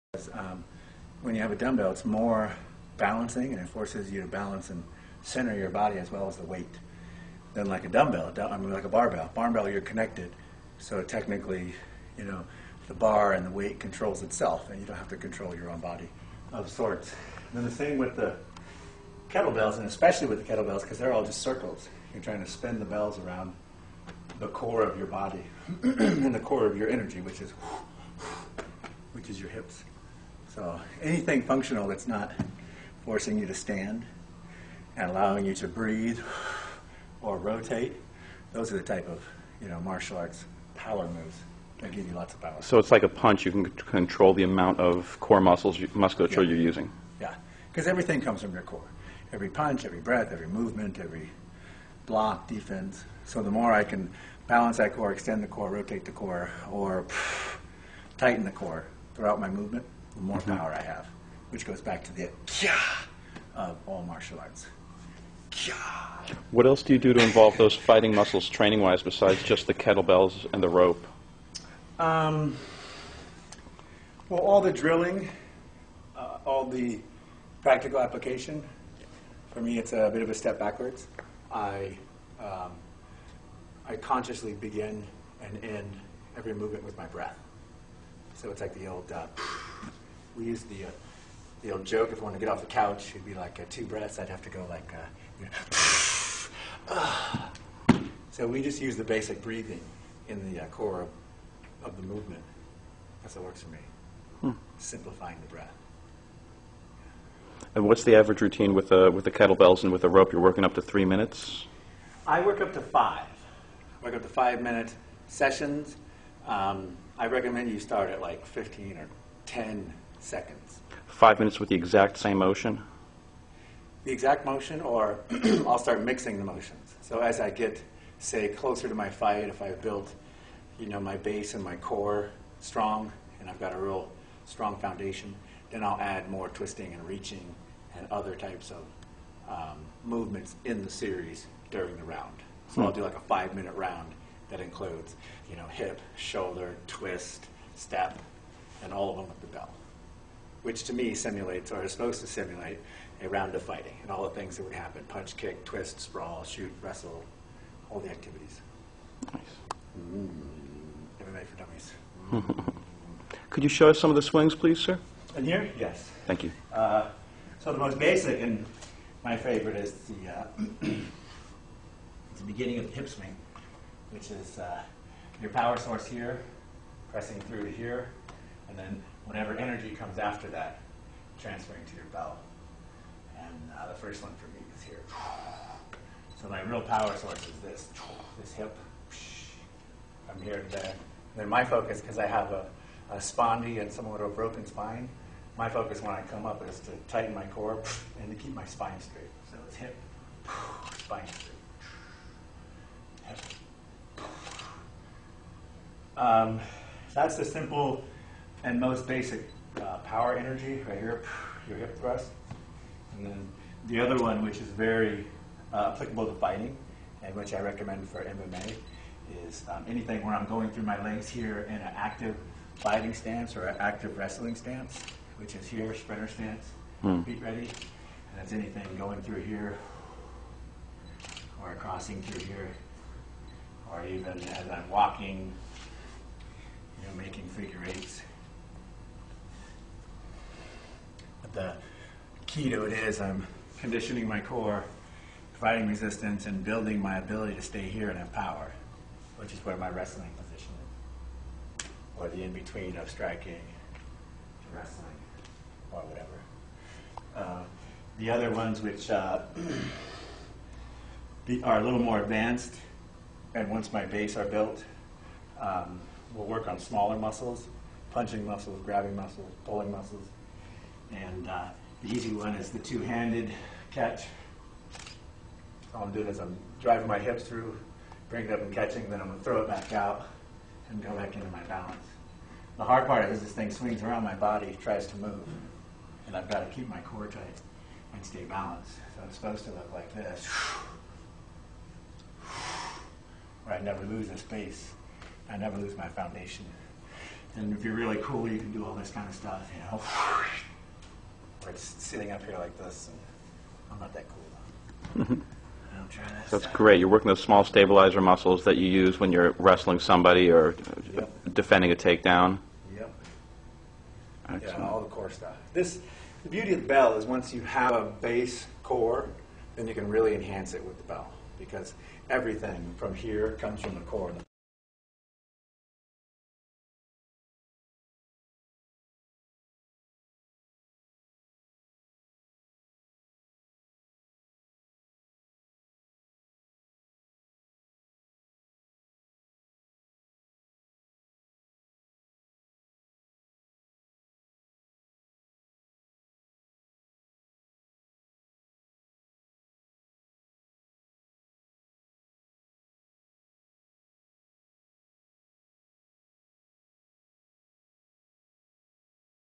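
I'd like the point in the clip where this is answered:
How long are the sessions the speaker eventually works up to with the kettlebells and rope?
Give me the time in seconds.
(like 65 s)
114 s.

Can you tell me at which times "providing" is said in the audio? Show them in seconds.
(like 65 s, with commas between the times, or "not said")
245 s.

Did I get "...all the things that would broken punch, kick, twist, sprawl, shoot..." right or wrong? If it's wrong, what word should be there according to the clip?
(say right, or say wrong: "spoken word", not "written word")
wrong: "happen", not "broken".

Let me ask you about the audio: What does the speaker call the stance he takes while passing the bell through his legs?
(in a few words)
Sprinter stance.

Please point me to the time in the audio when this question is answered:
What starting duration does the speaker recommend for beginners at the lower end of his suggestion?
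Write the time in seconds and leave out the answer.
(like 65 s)
119 s.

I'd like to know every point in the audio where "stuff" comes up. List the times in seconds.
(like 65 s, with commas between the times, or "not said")
299 s, 315 s.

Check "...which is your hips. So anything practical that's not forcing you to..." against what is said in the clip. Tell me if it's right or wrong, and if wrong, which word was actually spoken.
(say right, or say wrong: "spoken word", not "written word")
wrong: "functional", not "practical".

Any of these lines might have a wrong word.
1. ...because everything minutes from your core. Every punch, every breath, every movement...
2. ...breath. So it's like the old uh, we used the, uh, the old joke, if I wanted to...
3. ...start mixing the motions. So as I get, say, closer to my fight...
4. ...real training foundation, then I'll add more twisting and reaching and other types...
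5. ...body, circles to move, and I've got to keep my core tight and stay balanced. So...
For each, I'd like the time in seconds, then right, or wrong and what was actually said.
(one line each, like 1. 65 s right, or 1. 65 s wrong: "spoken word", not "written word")
1. 47 s wrong: "comes", not "minutes"
2. 87 s right
3. 125 s right
4. 133 s wrong: "strong", not "training"
5. 284 s wrong: "tries", not "circles".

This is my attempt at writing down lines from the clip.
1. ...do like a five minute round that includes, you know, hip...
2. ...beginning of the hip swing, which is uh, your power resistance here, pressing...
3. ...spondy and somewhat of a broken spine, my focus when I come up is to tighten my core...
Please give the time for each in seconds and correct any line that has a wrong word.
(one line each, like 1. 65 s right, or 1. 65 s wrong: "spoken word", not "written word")
1. 142 s right
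2. 172 s wrong: "source", not "resistance"
3. 193 s right.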